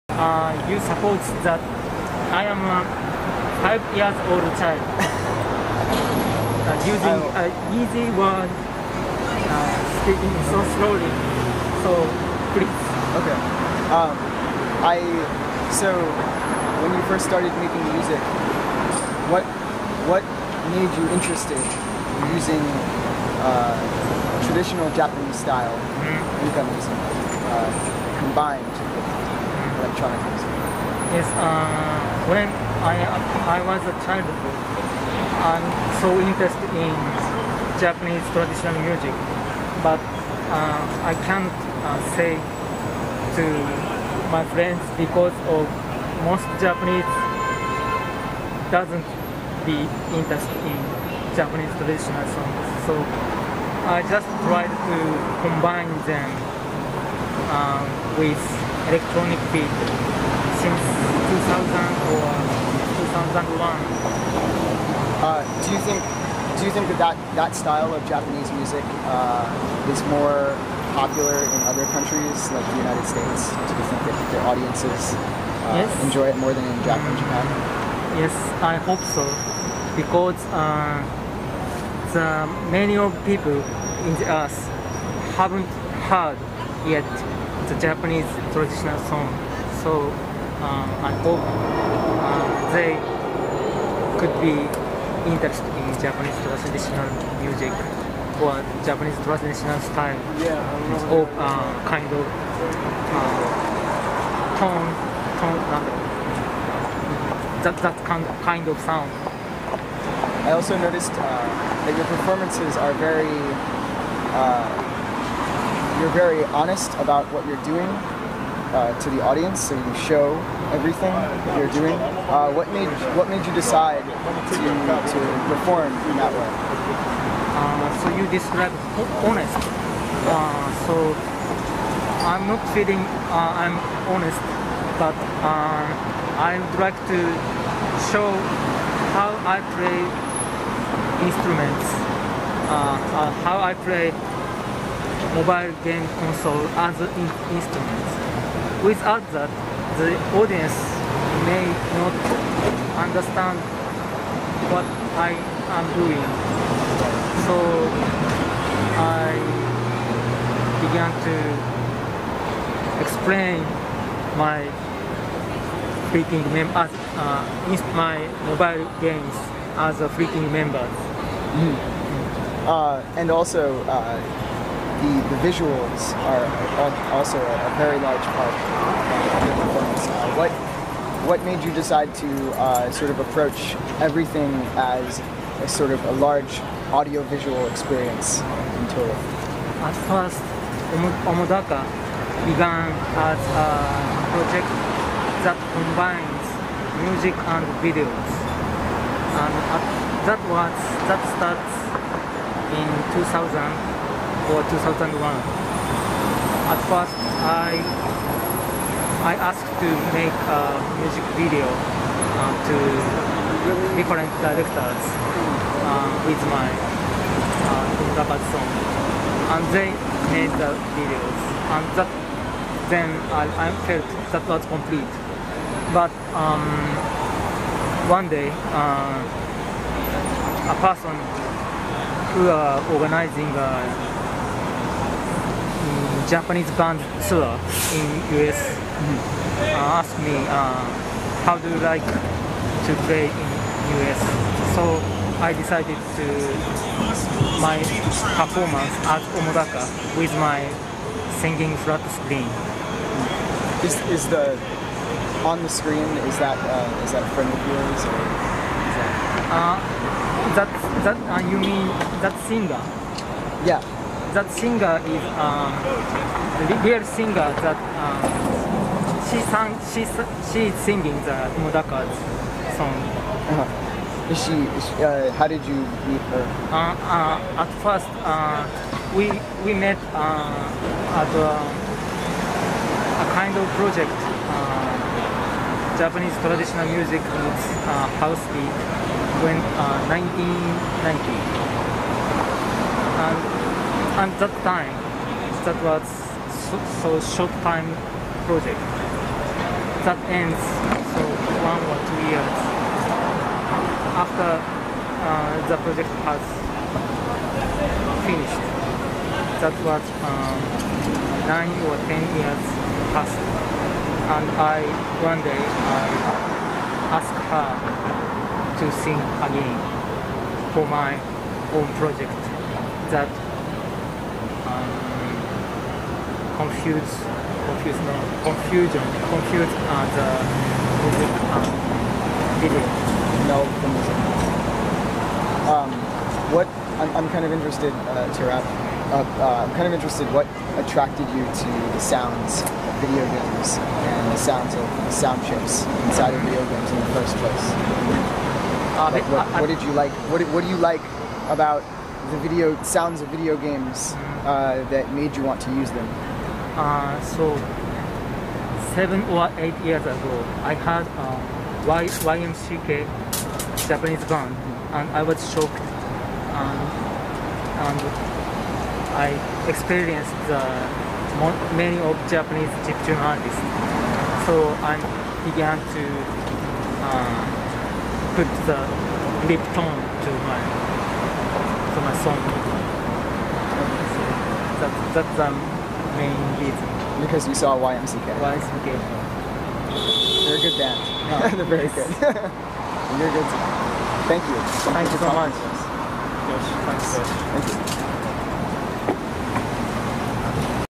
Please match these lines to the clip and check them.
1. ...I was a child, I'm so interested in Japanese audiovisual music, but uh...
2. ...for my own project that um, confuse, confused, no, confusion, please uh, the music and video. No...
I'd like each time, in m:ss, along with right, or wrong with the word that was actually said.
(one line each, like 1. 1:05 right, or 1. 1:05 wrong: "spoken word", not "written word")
1. 0:33 wrong: "traditional", not "audiovisual"
2. 5:20 wrong: "confuse", not "please".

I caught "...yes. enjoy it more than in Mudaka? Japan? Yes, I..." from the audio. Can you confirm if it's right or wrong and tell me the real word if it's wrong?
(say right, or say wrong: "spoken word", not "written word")
wrong: "Japan", not "Mudaka".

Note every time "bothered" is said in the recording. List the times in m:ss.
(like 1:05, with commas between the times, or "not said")
not said.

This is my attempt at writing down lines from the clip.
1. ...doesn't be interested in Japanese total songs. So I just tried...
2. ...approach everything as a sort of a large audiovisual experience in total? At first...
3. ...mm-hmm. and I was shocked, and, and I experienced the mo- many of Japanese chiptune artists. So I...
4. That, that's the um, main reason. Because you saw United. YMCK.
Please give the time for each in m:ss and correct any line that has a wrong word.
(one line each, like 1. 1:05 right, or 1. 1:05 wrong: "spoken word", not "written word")
1. 0:48 wrong: "traditional", not "total"
2. 3:03 right
3. 6:04 right
4. 6:24 wrong: "YMCK", not "United".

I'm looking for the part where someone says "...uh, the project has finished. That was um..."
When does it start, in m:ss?
5:04.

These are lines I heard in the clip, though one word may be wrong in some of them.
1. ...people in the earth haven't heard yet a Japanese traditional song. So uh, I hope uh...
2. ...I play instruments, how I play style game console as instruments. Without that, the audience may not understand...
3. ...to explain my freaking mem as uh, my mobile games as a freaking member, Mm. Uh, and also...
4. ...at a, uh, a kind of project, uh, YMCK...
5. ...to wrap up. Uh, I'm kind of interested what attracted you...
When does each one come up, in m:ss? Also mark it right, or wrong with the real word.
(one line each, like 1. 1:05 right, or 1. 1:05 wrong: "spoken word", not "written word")
1. 1:23 right
2. 2:19 wrong: "mobile", not "style"
3. 2:41 right
4. 4:41 wrong: "Japanese", not "YMCK"
5. 5:38 right.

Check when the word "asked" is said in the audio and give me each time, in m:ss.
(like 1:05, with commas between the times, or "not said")
3:29, 3:59, 5:17.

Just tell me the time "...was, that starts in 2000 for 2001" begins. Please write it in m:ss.
3:20.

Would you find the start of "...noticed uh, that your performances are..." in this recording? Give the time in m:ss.
1:50.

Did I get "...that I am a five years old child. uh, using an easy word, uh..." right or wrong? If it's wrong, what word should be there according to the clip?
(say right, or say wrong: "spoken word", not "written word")
right.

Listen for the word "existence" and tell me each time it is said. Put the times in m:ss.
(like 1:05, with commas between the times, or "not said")
not said.